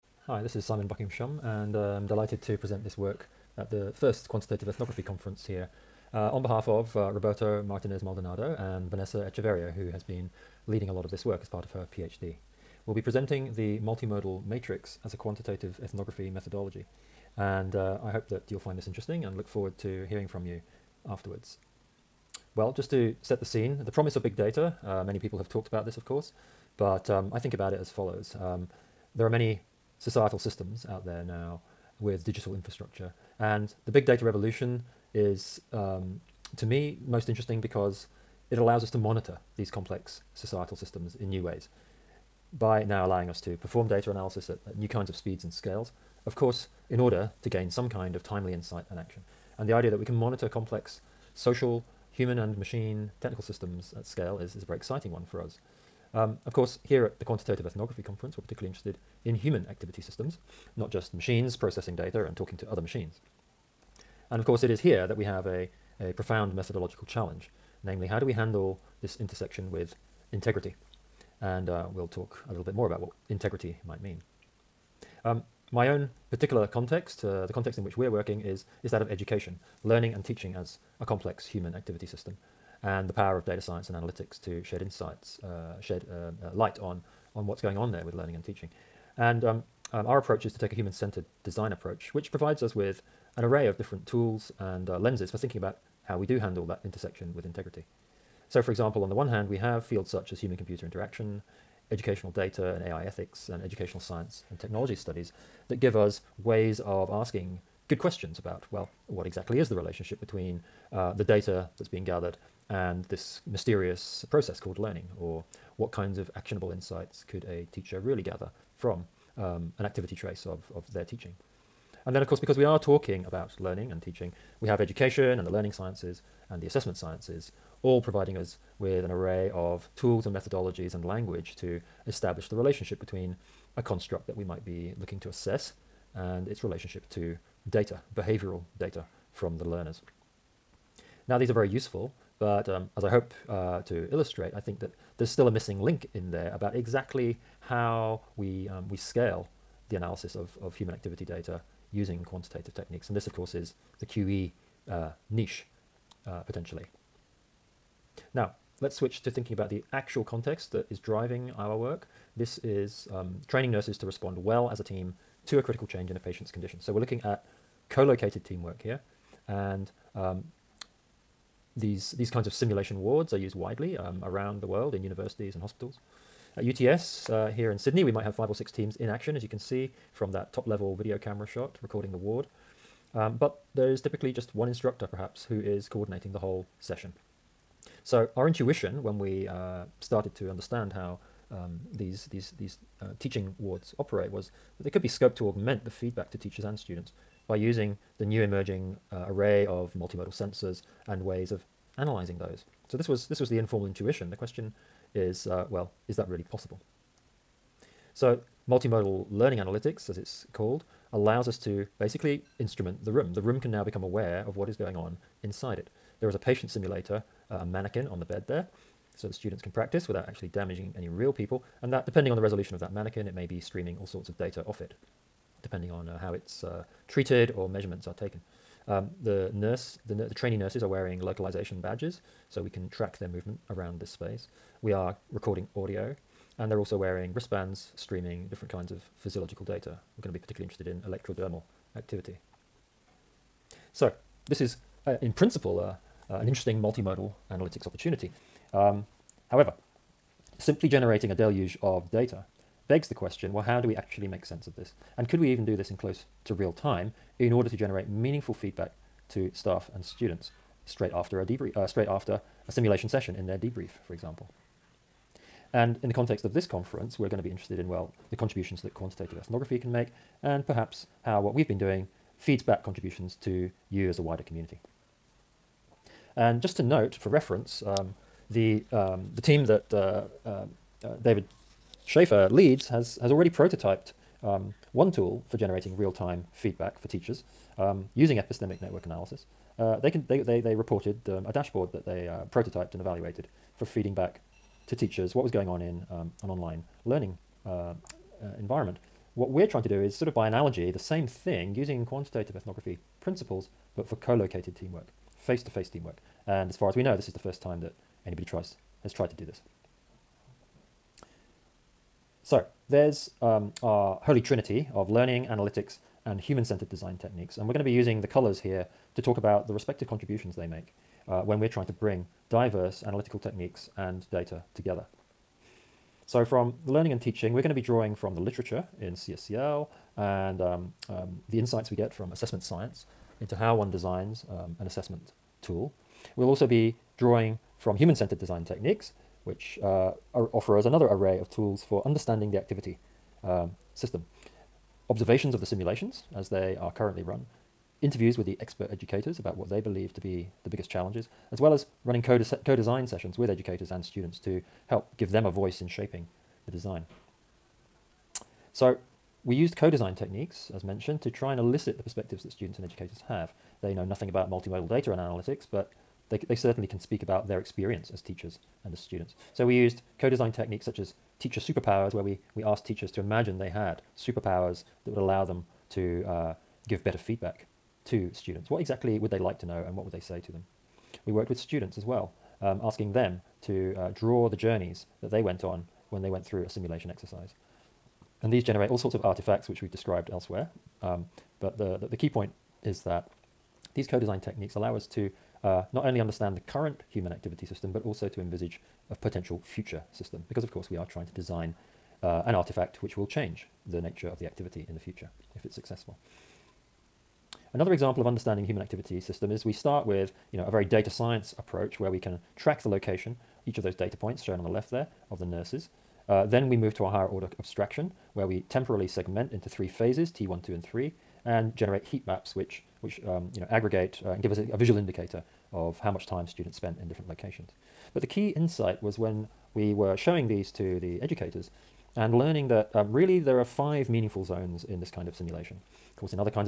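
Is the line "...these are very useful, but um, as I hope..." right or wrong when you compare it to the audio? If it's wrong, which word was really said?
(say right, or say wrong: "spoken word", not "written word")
right.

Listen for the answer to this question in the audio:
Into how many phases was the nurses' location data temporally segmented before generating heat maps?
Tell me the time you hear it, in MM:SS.
06:59.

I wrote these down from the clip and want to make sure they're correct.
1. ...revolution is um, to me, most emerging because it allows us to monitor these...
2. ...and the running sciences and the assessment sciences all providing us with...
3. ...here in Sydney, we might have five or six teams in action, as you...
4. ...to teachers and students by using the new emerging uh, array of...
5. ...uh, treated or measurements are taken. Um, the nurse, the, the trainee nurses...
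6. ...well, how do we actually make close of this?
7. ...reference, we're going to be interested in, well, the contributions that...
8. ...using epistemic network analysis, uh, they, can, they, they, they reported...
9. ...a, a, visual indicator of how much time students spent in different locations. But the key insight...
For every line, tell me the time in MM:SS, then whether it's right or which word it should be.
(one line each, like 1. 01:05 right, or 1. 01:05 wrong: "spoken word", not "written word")
1. 00:34 wrong: "interesting", not "emerging"
2. 02:05 wrong: "learning", not "running"
3. 02:57 right
4. 03:16 right
5. 03:46 right
6. 04:13 wrong: "sense", not "close"
7. 04:26 wrong: "conference", not "reference"
8. 04:48 right
9. 07:04 right.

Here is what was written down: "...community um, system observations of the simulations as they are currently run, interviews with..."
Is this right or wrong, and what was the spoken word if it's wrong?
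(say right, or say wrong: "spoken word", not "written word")
wrong: "activity", not "community".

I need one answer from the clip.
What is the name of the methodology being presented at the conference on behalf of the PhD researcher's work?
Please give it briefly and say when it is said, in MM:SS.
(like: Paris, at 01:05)
Multimodal matrix, at 00:13.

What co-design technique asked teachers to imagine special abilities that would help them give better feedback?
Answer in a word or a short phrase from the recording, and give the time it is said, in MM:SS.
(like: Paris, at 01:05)
Teacher superpowers, at 06:11.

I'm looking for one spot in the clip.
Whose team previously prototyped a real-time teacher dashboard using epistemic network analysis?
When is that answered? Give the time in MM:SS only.
04:41.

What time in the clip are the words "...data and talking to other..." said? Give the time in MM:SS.
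01:01.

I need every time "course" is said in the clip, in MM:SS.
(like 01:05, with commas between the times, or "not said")
00:26, 00:46, 00:56, 01:04, 02:02, 02:33, 06:40.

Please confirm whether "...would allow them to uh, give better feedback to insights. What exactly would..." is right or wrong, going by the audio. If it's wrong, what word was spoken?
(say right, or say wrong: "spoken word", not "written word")
wrong: "students", not "insights".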